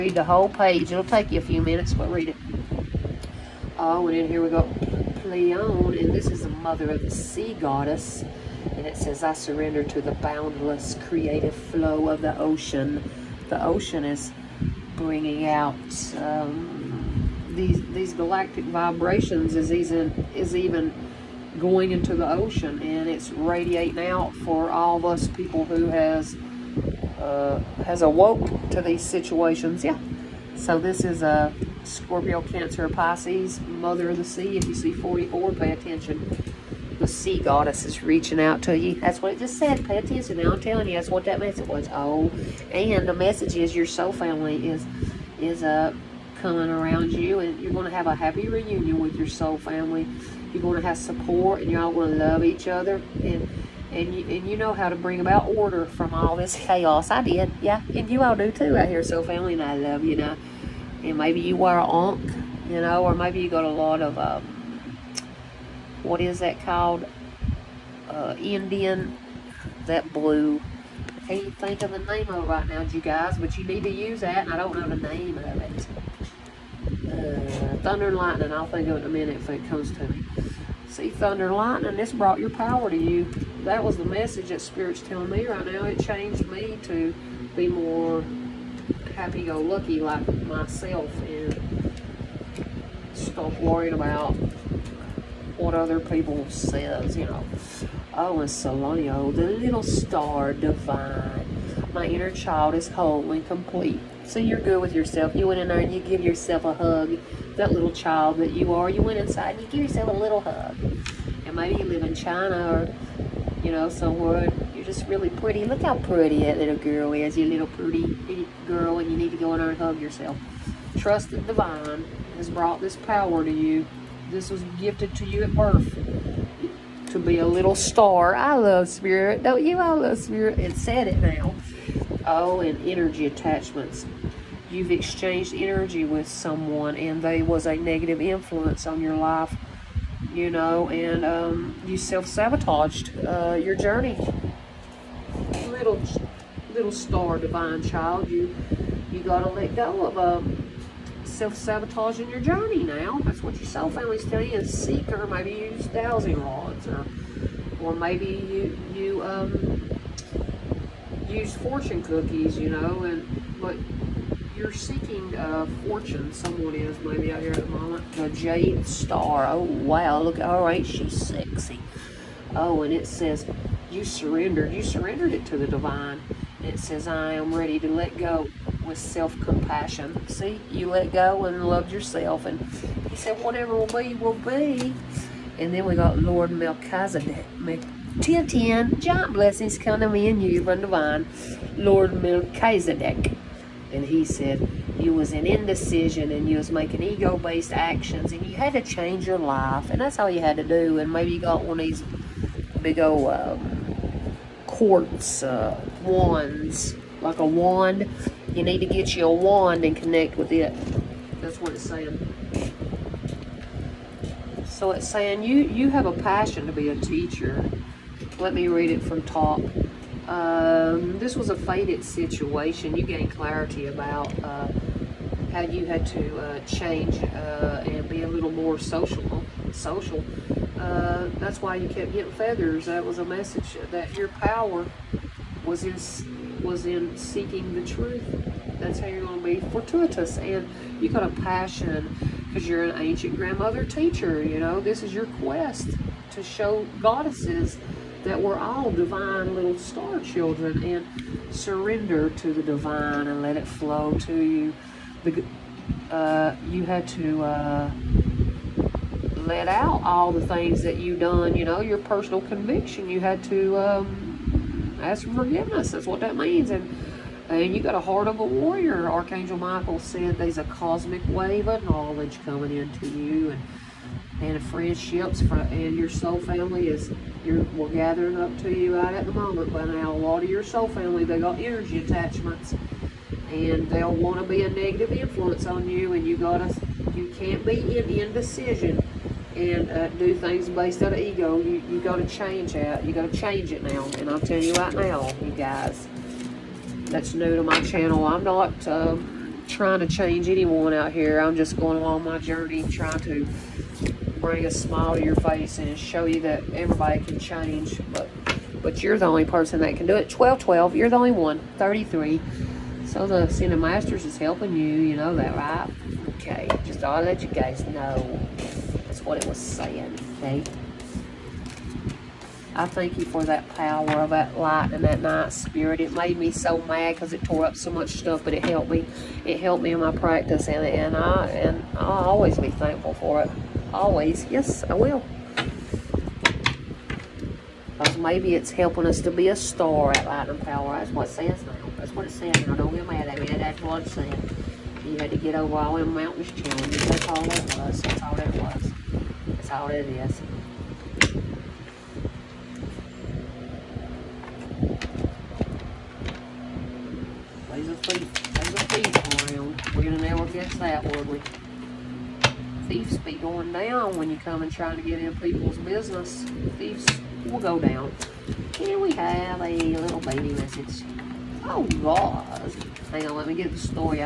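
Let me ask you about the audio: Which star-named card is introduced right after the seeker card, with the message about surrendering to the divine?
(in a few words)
The jade star.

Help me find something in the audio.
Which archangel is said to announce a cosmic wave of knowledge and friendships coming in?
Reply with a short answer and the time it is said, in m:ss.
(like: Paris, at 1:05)
Archangel Michael, at 4:29.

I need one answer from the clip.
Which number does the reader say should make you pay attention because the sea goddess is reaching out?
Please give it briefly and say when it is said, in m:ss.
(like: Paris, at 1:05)
44, at 0:34.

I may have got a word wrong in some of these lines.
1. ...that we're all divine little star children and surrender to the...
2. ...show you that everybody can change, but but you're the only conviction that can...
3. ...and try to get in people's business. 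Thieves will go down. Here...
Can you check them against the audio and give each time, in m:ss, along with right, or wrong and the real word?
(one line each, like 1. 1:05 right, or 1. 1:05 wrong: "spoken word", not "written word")
1. 4:08 right
2. 5:05 wrong: "person", not "conviction"
3. 6:04 right.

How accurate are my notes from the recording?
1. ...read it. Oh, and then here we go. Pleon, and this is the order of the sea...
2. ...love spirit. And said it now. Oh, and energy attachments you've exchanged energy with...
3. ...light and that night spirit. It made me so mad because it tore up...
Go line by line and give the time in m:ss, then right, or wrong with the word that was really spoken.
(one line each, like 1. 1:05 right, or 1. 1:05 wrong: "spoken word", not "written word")
1. 0:02 wrong: "mother", not "order"
2. 2:09 right
3. 5:24 right.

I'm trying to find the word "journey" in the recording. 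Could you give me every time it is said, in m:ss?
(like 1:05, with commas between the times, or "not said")
2:23, 2:32, 5:02.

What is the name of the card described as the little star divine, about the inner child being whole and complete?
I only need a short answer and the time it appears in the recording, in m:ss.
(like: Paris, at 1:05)
Solonio, at 1:38.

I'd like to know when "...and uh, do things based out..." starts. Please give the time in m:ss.
4:49.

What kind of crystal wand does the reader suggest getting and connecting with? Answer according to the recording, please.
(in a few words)
quartz.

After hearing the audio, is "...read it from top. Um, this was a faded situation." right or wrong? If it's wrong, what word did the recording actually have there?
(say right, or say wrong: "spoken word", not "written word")
right.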